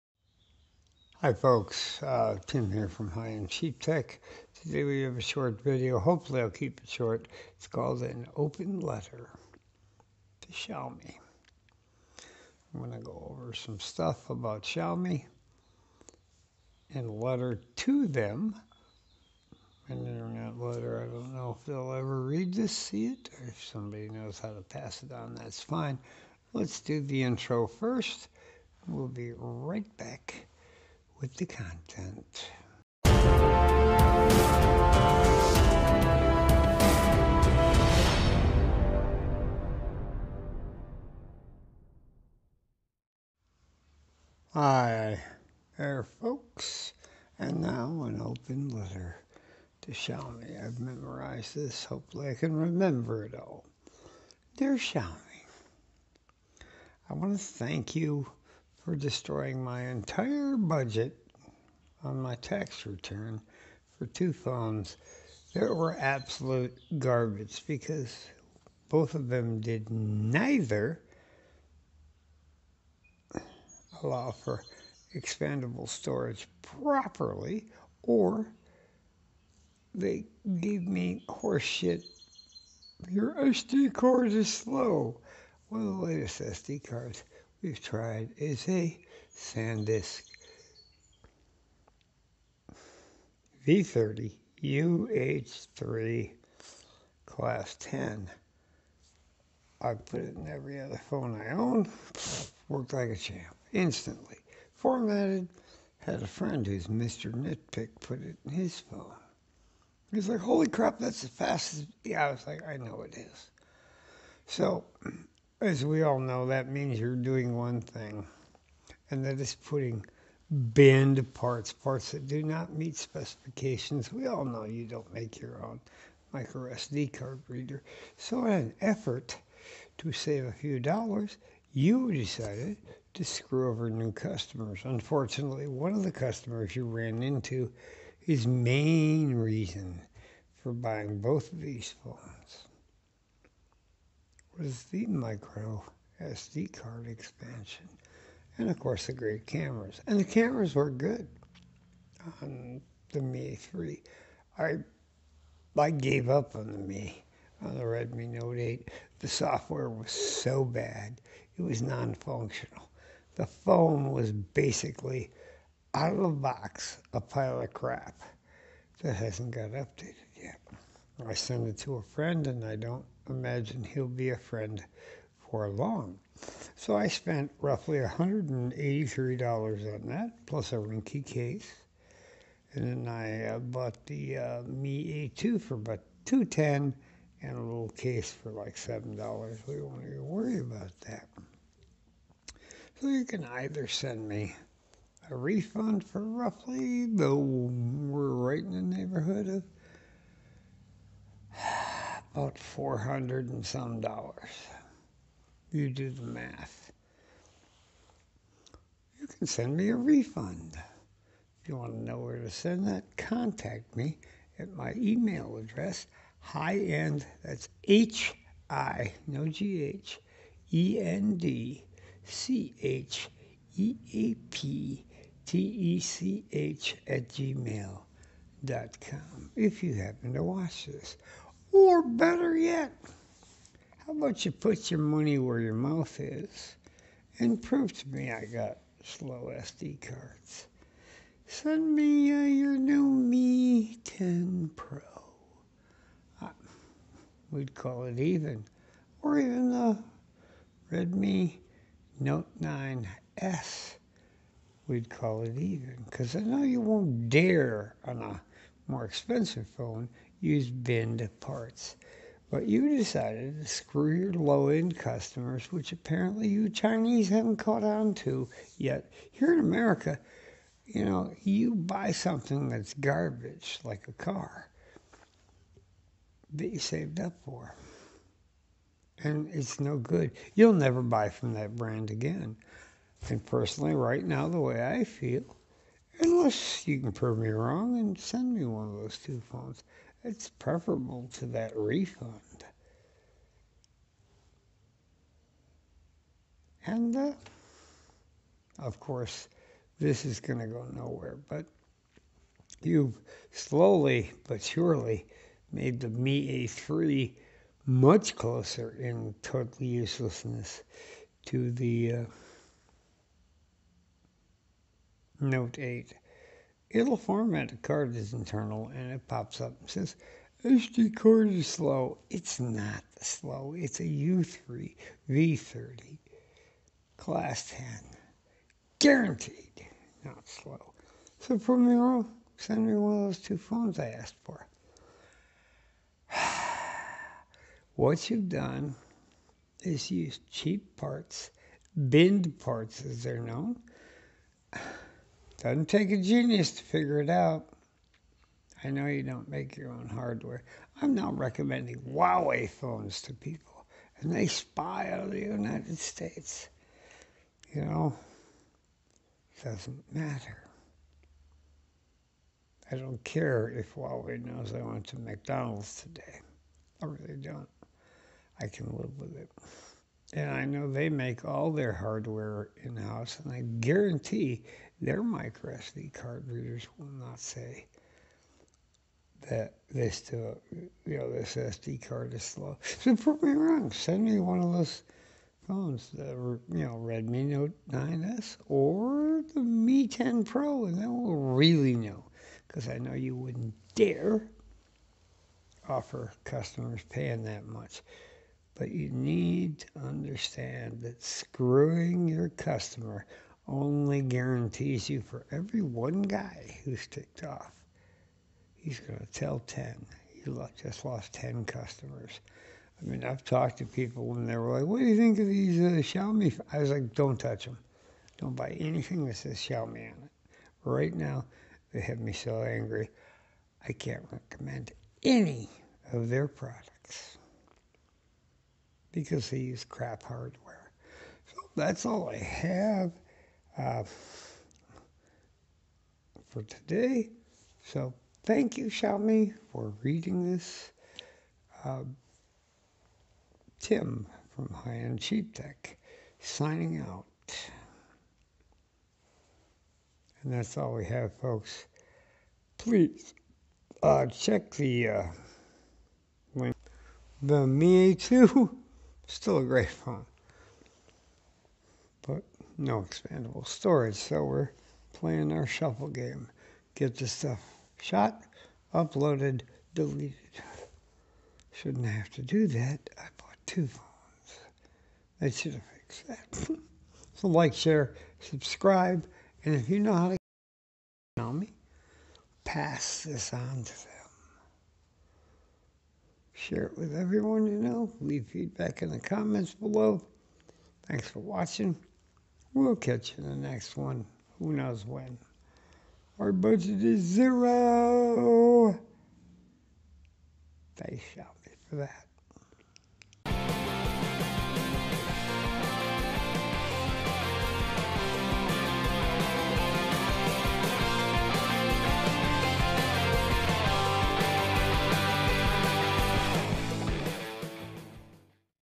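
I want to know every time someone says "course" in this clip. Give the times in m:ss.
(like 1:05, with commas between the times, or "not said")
2:28, 4:58.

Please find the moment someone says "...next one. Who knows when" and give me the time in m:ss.
8:13.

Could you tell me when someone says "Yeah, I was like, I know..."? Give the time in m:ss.
1:52.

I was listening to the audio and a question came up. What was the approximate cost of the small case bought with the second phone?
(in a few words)
$7.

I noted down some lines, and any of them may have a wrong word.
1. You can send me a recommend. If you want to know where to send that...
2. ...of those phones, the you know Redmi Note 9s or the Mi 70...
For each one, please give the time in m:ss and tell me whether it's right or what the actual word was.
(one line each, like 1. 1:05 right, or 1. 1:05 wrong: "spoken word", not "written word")
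1. 3:29 wrong: "refund", not "recommend"
2. 6:24 wrong: "10", not "70".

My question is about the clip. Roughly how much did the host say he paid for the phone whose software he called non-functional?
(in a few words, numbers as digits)
$183.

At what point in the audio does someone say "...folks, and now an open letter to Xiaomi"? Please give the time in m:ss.
0:46.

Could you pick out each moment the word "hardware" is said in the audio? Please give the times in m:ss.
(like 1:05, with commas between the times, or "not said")
5:50, 6:11, 7:10.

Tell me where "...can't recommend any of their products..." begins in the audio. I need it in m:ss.
7:03.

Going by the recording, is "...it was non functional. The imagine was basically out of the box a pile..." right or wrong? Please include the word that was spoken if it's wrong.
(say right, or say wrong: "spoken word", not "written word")
wrong: "phone", not "imagine".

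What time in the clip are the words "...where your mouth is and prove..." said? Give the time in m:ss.
3:55.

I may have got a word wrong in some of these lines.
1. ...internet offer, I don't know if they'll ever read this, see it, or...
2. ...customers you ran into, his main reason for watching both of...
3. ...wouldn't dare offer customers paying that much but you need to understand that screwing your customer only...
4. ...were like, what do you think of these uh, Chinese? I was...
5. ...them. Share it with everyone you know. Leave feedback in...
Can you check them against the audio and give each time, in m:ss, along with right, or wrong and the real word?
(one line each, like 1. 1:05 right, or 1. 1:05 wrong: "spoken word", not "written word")
1. 0:20 wrong: "letter", not "offer"
2. 2:16 wrong: "buying", not "watching"
3. 6:33 right
4. 6:54 wrong: "Xiaomi", not "Chinese"
5. 8:04 right.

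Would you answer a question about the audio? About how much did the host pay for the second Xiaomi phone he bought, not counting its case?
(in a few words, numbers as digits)
210.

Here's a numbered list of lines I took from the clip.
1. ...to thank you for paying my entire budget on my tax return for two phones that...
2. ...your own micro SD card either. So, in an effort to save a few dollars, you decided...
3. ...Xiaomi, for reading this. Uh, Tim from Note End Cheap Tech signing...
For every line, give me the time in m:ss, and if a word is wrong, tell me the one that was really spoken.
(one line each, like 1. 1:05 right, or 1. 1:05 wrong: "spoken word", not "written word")
1. 0:57 wrong: "destroying", not "paying"
2. 2:05 wrong: "reader", not "either"
3. 7:18 wrong: "High", not "Note".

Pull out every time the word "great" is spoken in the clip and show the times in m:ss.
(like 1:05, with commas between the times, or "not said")
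2:29, 7:39.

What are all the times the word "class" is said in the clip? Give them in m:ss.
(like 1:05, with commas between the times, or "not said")
1:37, 5:27.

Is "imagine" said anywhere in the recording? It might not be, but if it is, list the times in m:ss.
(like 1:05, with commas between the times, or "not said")
2:53.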